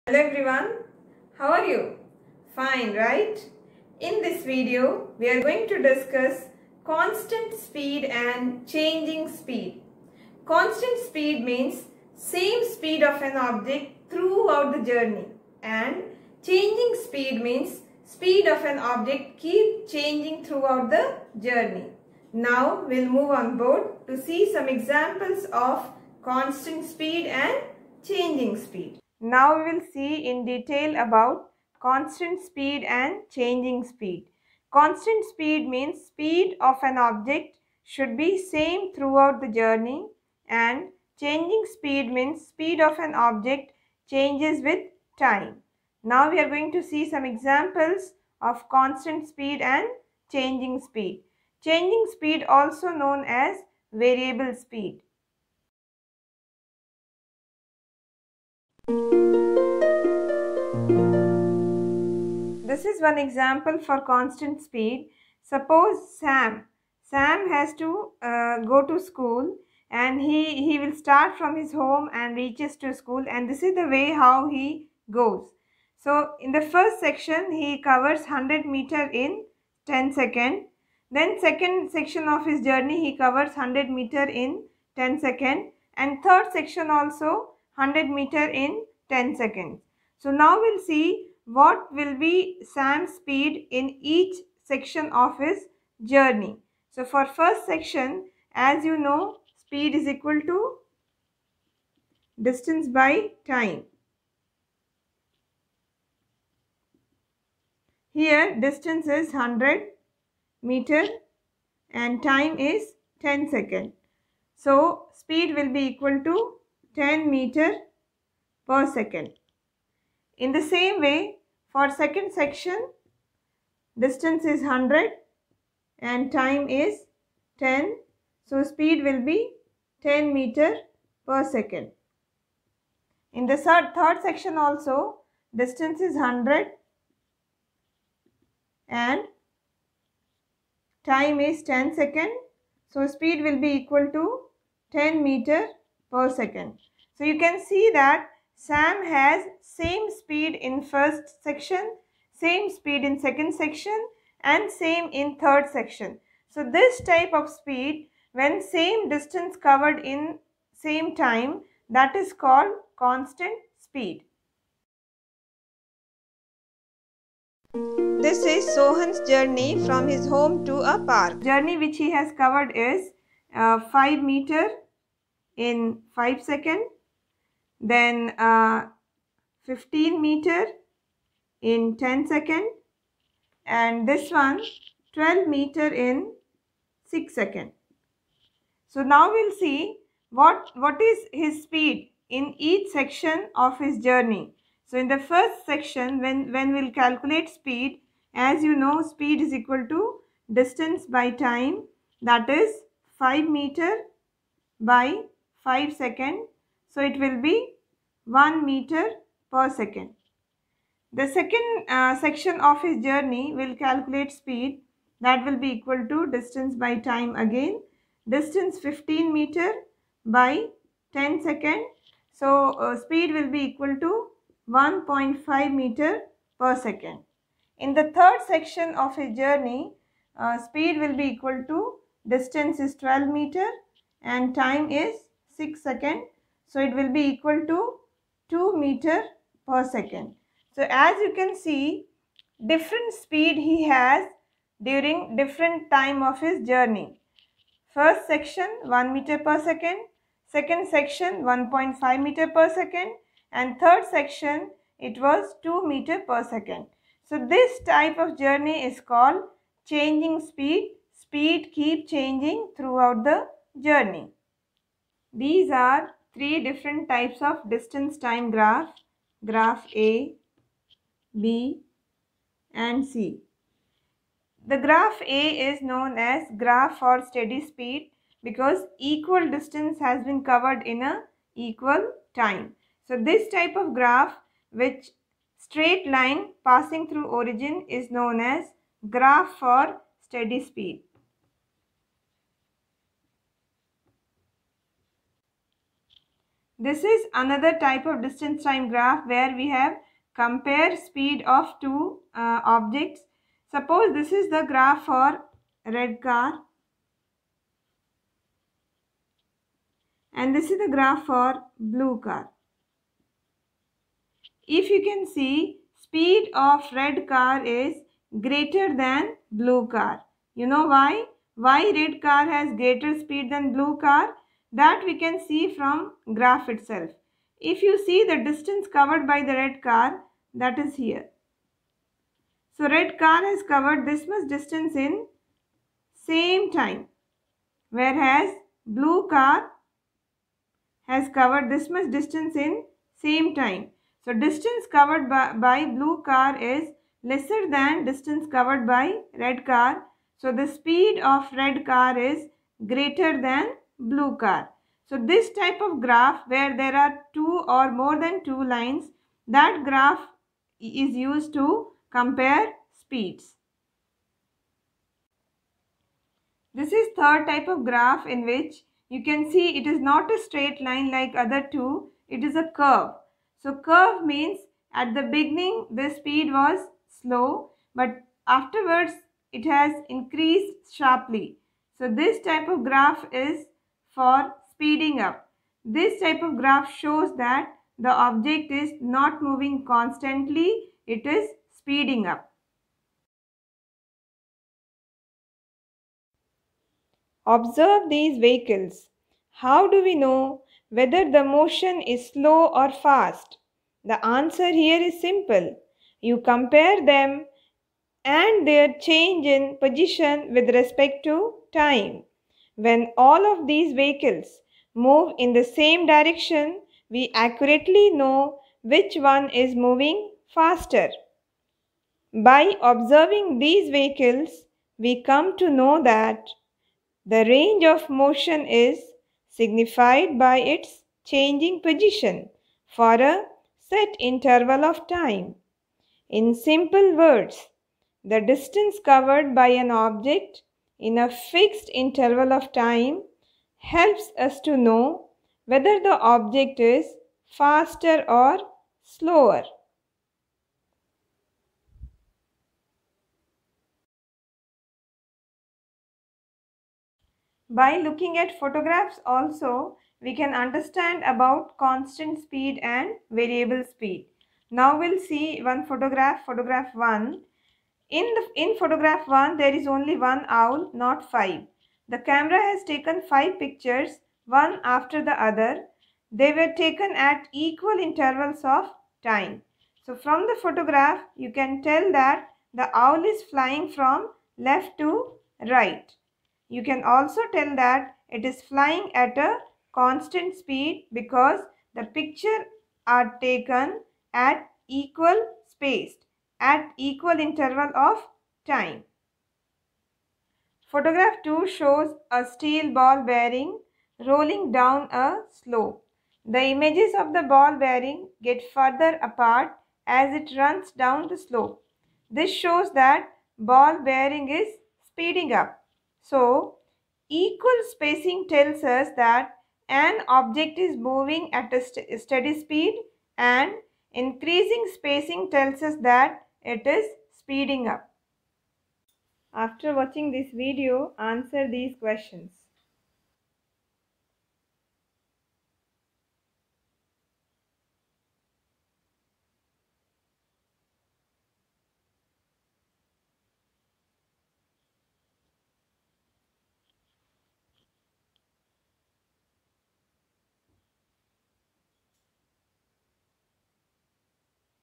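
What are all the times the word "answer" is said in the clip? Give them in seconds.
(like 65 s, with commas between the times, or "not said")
404 s, 531 s.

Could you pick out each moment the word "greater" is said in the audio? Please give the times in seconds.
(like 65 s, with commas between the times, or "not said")
318 s, 322 s, 352 s.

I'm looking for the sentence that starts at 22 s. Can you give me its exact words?
Now we'll move on board to see some examples of constant speed and changing speed.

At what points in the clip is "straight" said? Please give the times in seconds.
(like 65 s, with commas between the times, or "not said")
285 s, 370 s.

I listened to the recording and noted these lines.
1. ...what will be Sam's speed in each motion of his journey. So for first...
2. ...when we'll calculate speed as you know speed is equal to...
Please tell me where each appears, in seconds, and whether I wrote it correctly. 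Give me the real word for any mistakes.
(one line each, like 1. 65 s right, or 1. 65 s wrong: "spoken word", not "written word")
1. 91 s wrong: "section", not "motion"
2. 196 s right.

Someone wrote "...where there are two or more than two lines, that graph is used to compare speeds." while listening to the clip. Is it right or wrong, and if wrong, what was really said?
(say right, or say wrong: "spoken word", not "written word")
right.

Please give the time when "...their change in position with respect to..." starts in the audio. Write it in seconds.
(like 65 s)
408 s.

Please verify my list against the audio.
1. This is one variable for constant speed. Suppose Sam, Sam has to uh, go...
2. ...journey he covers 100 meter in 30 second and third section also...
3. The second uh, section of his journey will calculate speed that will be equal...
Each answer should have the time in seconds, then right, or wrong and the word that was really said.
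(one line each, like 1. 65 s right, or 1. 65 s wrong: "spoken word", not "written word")
1. 62 s wrong: "example", not "variable"
2. 82 s wrong: "10", not "30"
3. 211 s right.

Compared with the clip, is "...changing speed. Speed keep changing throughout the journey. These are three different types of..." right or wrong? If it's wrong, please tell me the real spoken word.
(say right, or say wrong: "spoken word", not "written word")
right.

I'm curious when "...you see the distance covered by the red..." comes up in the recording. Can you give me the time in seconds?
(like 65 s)
327 s.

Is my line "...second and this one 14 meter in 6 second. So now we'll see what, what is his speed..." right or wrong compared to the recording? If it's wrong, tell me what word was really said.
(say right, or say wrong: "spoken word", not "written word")
wrong: "12", not "14".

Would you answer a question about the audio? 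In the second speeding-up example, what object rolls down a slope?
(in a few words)
Steel ball bearing.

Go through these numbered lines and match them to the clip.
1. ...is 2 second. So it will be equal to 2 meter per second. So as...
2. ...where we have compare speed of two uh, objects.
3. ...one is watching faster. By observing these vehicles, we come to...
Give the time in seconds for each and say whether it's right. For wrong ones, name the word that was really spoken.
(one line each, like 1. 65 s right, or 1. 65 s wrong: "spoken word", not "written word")
1. 234 s wrong: "6", not "2"
2. 299 s right
3. 419 s wrong: "moving", not "watching".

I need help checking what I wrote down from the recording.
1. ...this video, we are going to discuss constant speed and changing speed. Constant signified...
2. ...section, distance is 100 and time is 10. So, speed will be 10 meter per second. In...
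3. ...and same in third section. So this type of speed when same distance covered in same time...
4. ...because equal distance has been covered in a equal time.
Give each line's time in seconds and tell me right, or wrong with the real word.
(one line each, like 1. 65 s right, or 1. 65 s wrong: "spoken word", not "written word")
1. 4 s wrong: "speed", not "signified"
2. 122 s right
3. 154 s right
4. 278 s right.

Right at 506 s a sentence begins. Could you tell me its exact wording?
The images of the ball bearing get further apart as it runs down the slope.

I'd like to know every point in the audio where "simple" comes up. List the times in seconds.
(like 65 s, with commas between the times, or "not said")
405 s, 436 s.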